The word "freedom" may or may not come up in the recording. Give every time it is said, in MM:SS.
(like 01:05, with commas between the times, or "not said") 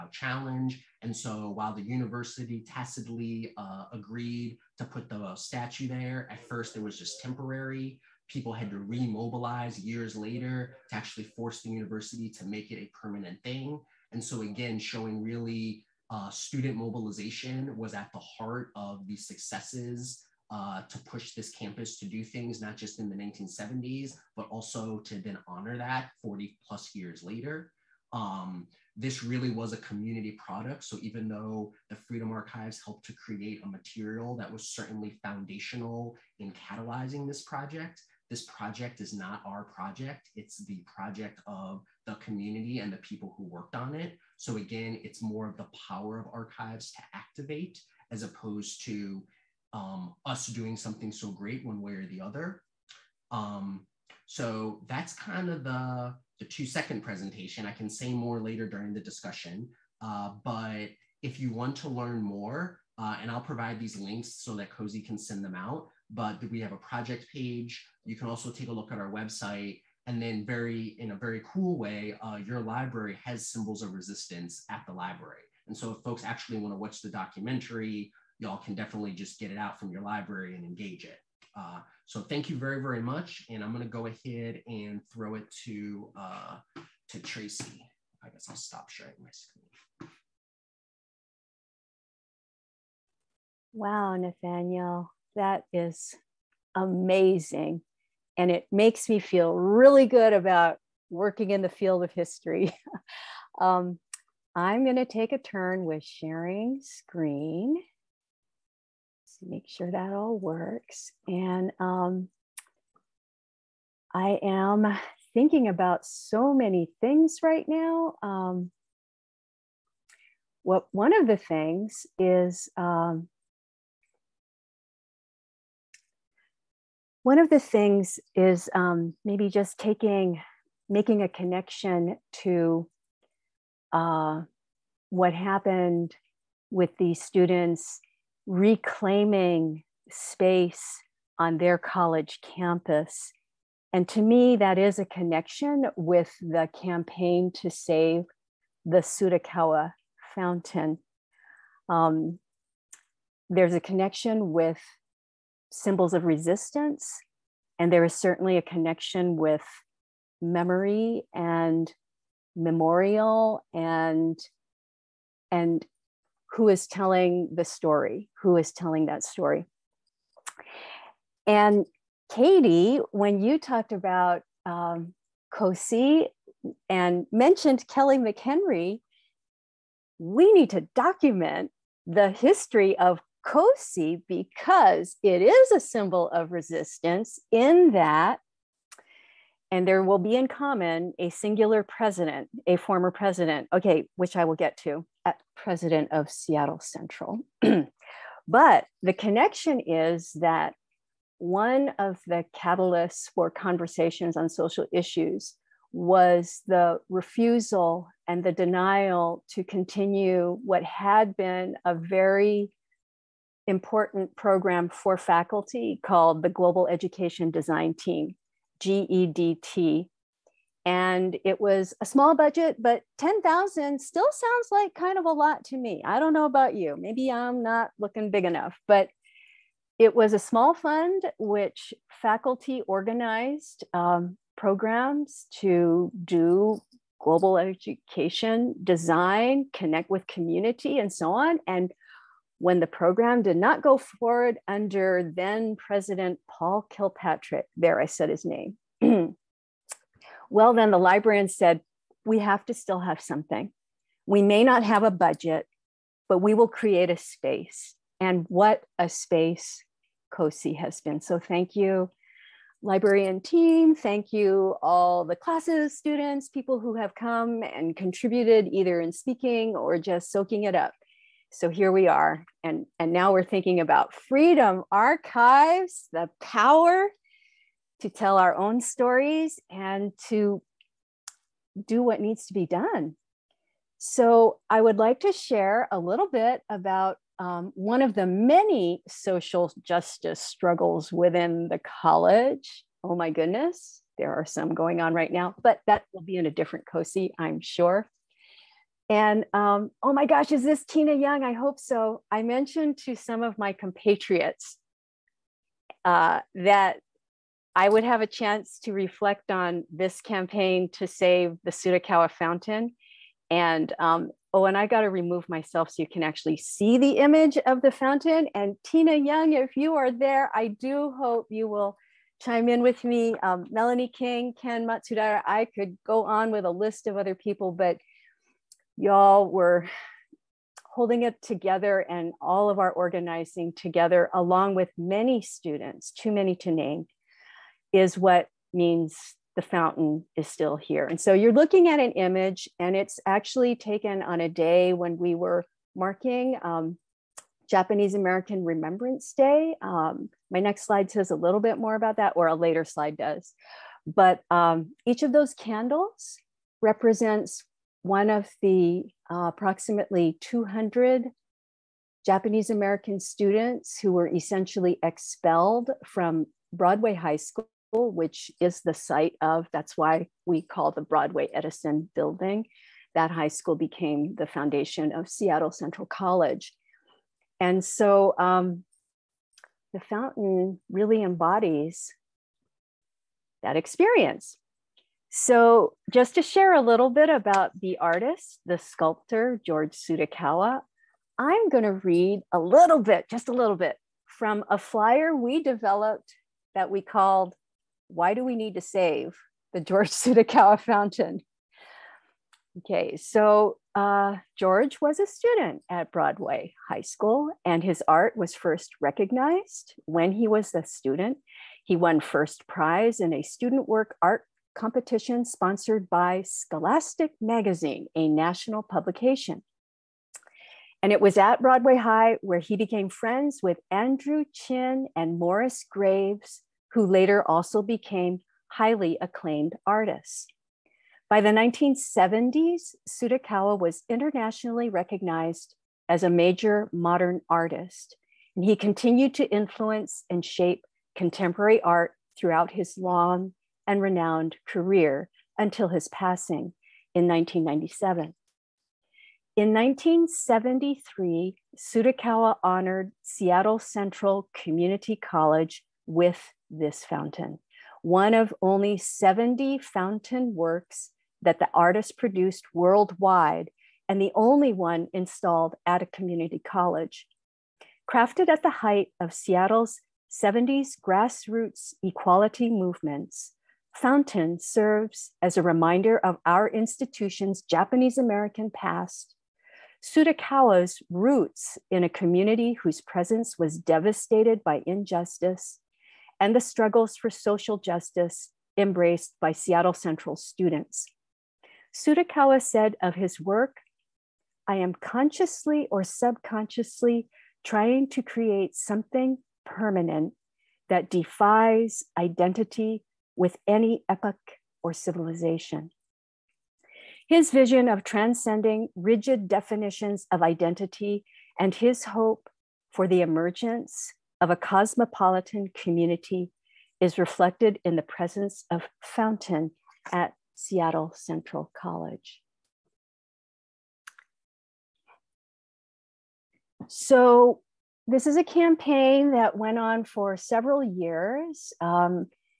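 00:31, 04:34.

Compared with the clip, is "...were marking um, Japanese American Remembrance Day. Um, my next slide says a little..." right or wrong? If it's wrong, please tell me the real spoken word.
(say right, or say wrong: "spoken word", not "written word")
right.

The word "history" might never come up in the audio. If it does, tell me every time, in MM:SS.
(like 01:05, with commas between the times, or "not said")
01:42, 03:02.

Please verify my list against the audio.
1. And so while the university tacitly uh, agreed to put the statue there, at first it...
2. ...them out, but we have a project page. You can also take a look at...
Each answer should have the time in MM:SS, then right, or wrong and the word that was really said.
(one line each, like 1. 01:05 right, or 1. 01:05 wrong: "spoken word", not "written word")
1. 00:01 right
2. 01:05 right.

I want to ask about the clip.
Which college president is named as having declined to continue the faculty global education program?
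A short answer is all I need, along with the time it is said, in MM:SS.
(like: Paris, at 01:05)
Paul Kilpatrick, at 04:06.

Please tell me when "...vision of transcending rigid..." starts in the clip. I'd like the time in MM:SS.
08:27.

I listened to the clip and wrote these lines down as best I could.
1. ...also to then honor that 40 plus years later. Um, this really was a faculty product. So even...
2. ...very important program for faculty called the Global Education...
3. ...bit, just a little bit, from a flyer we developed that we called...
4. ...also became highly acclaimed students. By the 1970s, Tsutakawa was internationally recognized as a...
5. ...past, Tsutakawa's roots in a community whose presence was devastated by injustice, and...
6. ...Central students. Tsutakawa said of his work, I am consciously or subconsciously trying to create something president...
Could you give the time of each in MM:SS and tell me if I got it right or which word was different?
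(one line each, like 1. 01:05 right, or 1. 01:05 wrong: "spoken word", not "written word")
1. 00:24 wrong: "community", not "faculty"
2. 03:31 right
3. 06:32 right
4. 07:07 wrong: "artists", not "students"
5. 07:58 right
6. 08:09 wrong: "permanent", not "president".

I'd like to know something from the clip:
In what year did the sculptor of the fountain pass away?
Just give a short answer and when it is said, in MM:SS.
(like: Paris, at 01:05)
1997, at 07:27.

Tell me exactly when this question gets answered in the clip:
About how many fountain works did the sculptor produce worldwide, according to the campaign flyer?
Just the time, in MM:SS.
07:38.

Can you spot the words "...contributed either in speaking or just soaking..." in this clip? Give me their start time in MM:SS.
04:27.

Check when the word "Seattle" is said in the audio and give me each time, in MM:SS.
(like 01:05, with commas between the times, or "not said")
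03:16, 06:15, 07:33, 07:49, 08:09, 08:40.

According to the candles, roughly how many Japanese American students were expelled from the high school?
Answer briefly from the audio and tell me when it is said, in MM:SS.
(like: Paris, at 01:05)
200, at 06:00.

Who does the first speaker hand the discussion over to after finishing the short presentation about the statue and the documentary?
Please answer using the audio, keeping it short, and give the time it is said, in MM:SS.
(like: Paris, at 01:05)
Tracy, at 01:27.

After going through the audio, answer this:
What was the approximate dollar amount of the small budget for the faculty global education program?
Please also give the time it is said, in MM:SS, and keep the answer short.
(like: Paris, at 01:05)
10,000, at 03:43.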